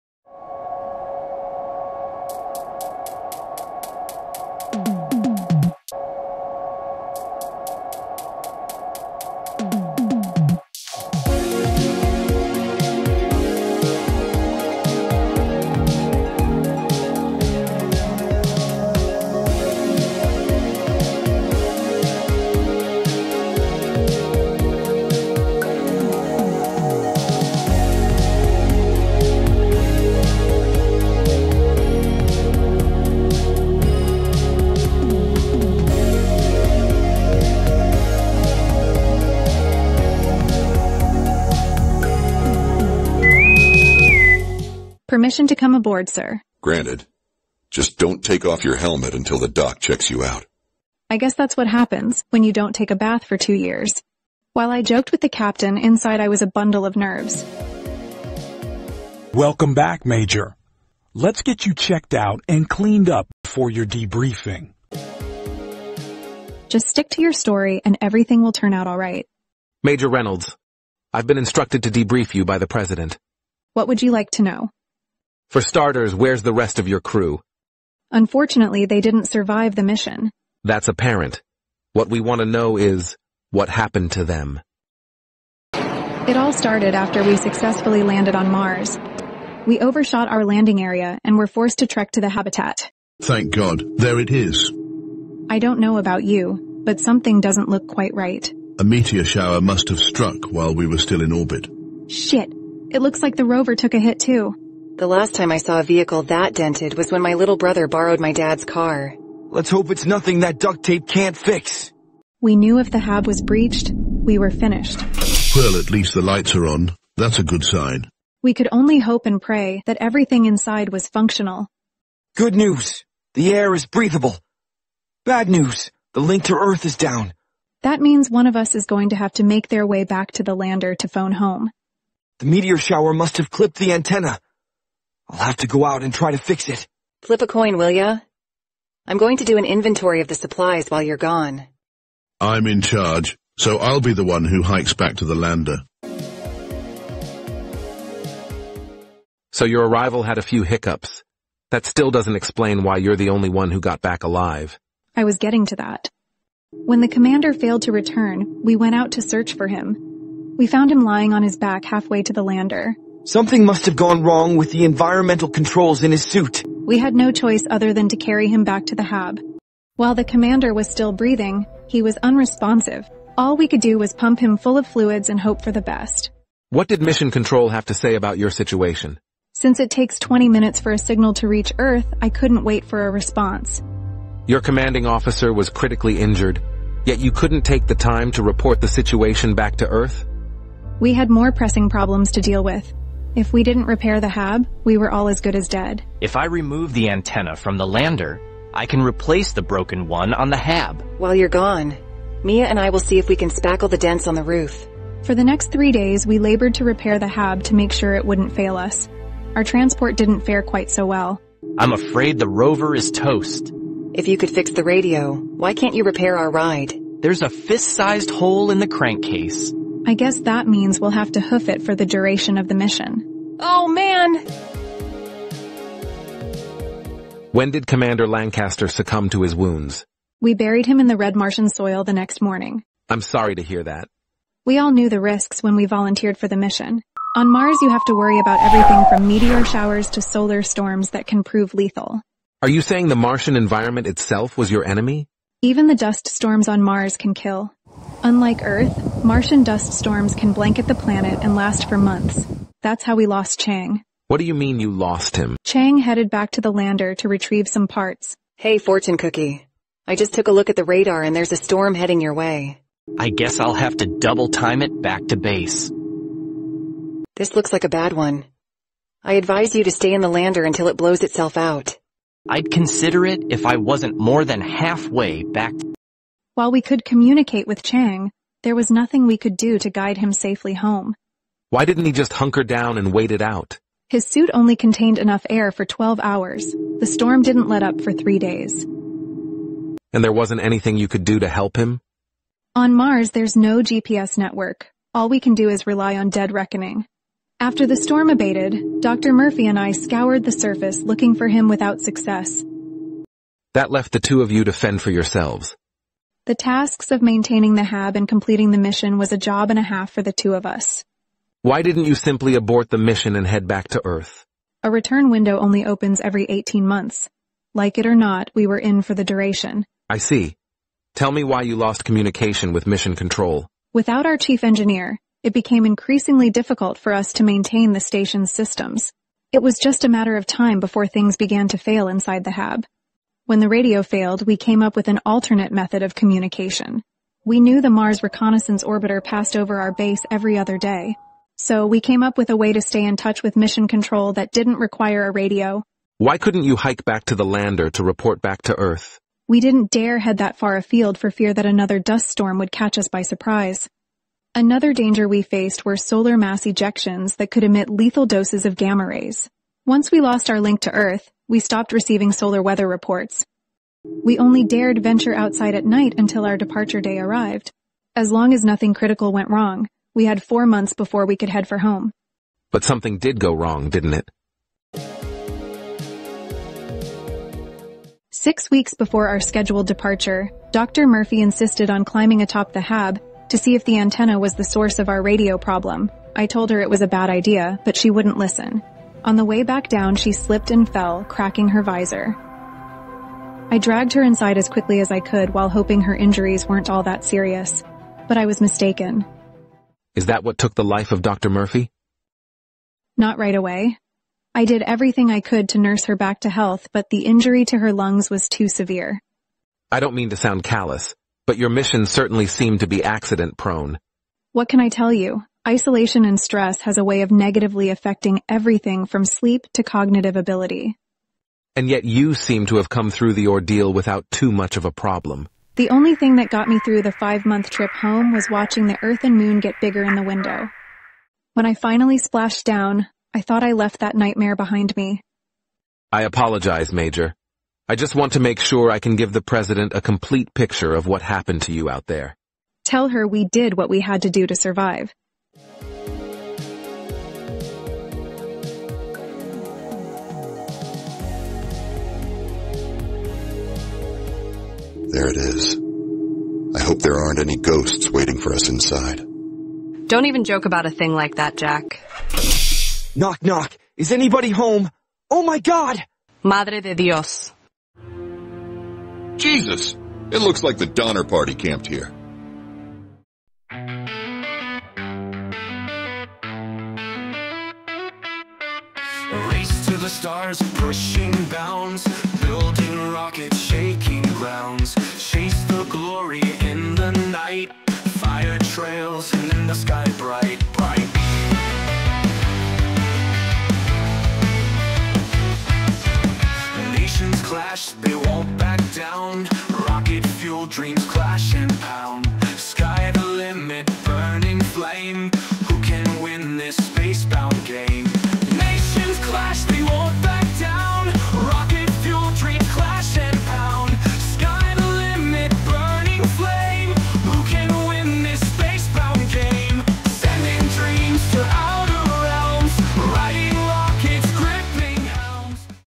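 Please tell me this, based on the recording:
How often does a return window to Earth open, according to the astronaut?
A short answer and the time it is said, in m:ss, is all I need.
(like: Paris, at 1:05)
Every 18 months, at 5:16.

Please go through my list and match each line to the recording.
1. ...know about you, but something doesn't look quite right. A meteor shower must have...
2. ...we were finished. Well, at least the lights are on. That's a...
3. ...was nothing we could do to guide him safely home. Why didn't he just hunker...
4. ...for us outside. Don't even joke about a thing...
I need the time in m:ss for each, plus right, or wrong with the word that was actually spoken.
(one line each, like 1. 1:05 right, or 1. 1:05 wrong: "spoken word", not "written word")
1. 1:35 right
2. 1:53 right
3. 4:38 right
4. 7:38 wrong: "inside", not "outside".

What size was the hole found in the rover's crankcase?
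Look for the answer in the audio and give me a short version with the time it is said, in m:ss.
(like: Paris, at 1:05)
Fist-sized, at 3:37.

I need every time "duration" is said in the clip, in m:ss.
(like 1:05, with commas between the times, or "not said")
3:42, 5:19.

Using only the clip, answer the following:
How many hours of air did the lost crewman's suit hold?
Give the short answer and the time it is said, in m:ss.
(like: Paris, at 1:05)
12 hours, at 4:45.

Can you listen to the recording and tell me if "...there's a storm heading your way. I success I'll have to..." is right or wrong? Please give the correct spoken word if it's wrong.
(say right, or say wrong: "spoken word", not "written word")
wrong: "guess", not "success".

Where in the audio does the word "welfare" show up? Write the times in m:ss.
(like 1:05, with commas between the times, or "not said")
not said.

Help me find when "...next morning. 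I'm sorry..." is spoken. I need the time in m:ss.
3:52.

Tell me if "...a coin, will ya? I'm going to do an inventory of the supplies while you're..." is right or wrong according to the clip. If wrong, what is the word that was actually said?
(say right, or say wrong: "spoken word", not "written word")
right.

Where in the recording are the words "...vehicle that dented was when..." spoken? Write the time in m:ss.
1:45.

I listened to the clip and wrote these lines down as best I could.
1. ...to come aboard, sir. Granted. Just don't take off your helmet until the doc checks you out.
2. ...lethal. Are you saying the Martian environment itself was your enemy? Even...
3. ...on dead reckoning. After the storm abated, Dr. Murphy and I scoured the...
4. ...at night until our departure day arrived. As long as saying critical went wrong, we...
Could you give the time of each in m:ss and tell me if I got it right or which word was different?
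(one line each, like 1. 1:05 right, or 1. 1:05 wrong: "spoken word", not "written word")
1. 0:45 right
2. 4:01 right
3. 4:56 right
4. 6:05 wrong: "nothing", not "saying".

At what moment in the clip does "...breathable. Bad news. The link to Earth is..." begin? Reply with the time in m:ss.
2:03.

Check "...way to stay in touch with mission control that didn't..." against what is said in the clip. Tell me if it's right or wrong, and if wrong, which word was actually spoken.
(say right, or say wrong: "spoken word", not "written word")
right.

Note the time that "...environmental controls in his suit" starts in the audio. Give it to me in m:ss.
2:44.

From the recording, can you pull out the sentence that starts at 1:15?
For starters, where's the rest of your crew?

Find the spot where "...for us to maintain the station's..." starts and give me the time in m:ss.
5:26.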